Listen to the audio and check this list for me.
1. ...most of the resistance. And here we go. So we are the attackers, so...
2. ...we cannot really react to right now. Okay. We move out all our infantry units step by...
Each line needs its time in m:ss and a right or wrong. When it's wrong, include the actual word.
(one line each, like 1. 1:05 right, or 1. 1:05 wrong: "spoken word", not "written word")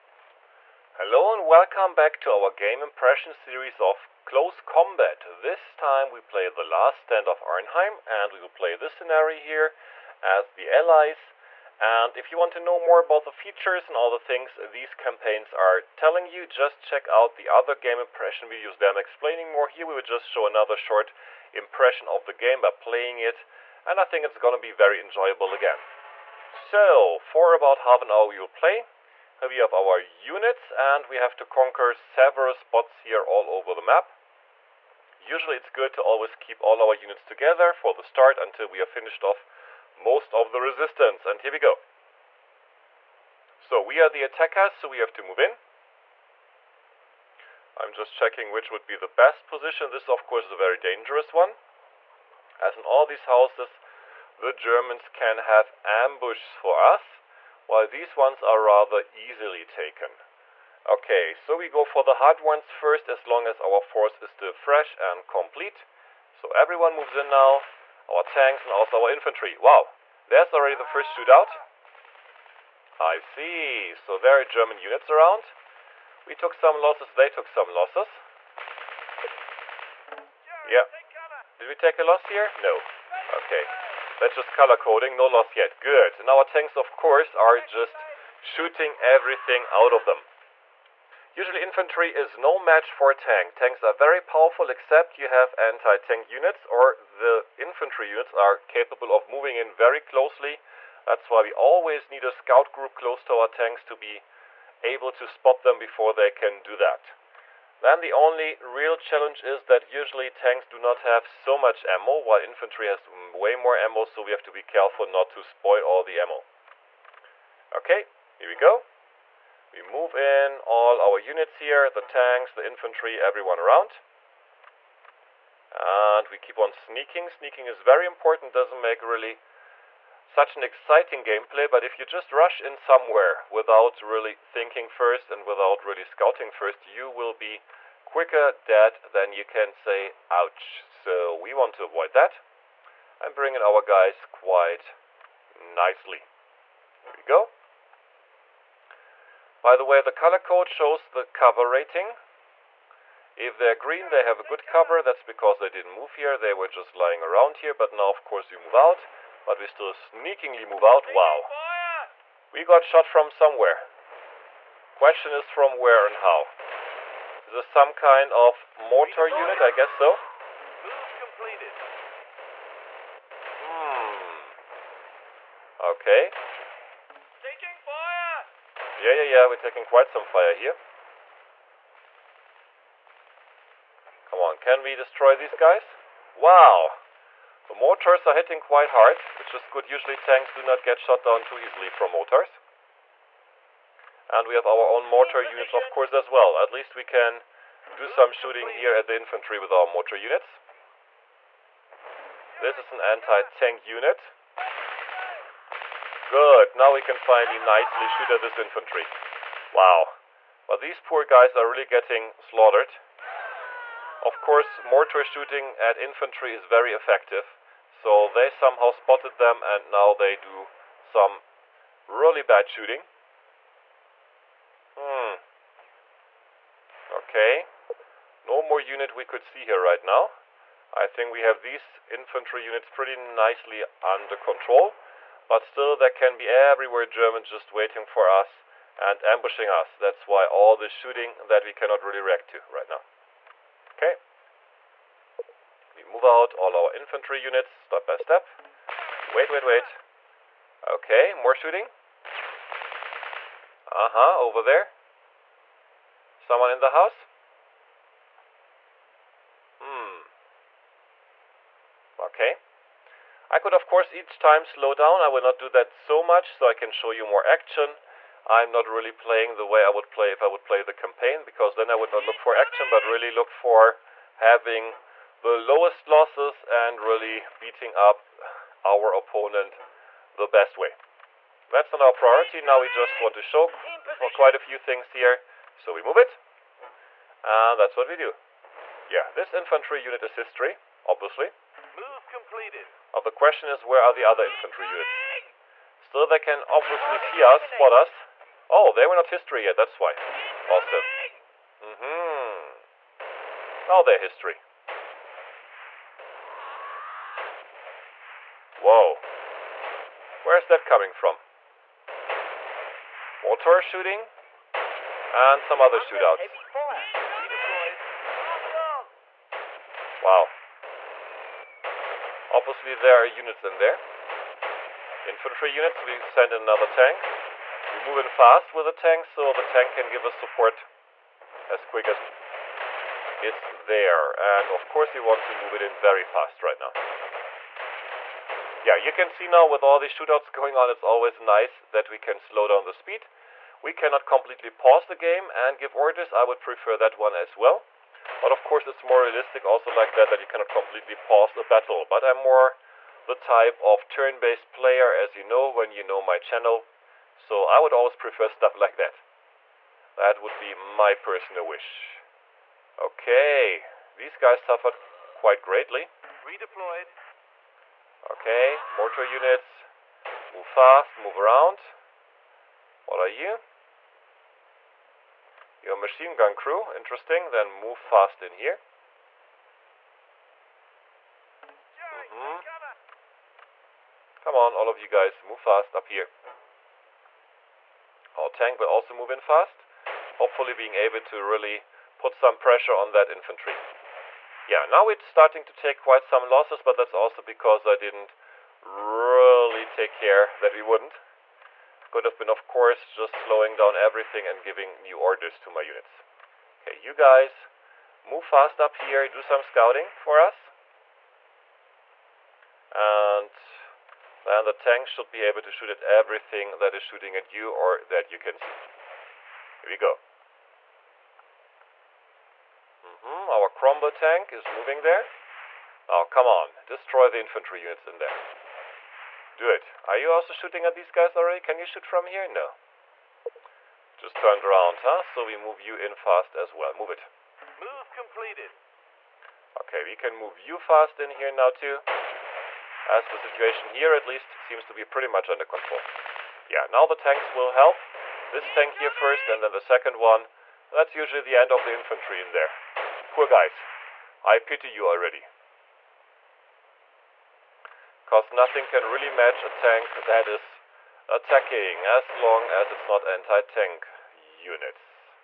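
1. 0:39 right
2. 4:01 right.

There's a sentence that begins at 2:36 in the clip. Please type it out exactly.
They were just lying around here.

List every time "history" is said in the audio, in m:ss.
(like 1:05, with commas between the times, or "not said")
4:50, 4:59, 5:04.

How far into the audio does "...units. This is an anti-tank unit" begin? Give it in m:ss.
3:20.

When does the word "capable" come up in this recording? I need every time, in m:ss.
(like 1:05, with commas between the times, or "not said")
1:38.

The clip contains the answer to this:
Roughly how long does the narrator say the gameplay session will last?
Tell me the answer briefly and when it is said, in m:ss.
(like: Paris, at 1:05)
About half an hour, at 0:27.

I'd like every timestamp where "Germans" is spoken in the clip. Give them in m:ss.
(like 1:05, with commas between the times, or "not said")
0:54, 1:14, 3:57.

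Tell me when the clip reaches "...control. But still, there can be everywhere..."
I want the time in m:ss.
3:54.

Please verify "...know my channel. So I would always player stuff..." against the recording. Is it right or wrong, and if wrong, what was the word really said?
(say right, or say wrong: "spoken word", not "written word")
wrong: "prefer", not "player".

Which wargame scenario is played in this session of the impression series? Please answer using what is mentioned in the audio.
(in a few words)
The last stand of Arnheim.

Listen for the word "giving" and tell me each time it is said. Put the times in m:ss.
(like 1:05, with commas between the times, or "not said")
6:44.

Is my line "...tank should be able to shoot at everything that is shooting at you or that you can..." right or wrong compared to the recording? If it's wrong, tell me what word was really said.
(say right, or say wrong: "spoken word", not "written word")
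right.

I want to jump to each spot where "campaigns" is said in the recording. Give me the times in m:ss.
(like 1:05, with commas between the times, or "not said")
0:14, 4:30.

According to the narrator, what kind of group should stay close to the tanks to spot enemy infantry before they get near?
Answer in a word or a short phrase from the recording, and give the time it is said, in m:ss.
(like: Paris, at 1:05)
A scout group, at 1:42.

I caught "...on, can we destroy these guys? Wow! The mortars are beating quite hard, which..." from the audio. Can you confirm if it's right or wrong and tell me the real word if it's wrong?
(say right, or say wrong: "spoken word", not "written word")
wrong: "hitting", not "beating".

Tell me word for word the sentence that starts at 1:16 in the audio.
We took some losses, they took some losses.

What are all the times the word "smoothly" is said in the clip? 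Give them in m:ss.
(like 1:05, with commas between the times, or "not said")
not said.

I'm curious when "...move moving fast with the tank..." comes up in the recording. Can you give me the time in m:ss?
5:27.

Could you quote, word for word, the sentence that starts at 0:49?
This of course is a very dangerous one.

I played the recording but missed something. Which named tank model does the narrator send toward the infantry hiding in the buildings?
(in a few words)
Cromwell.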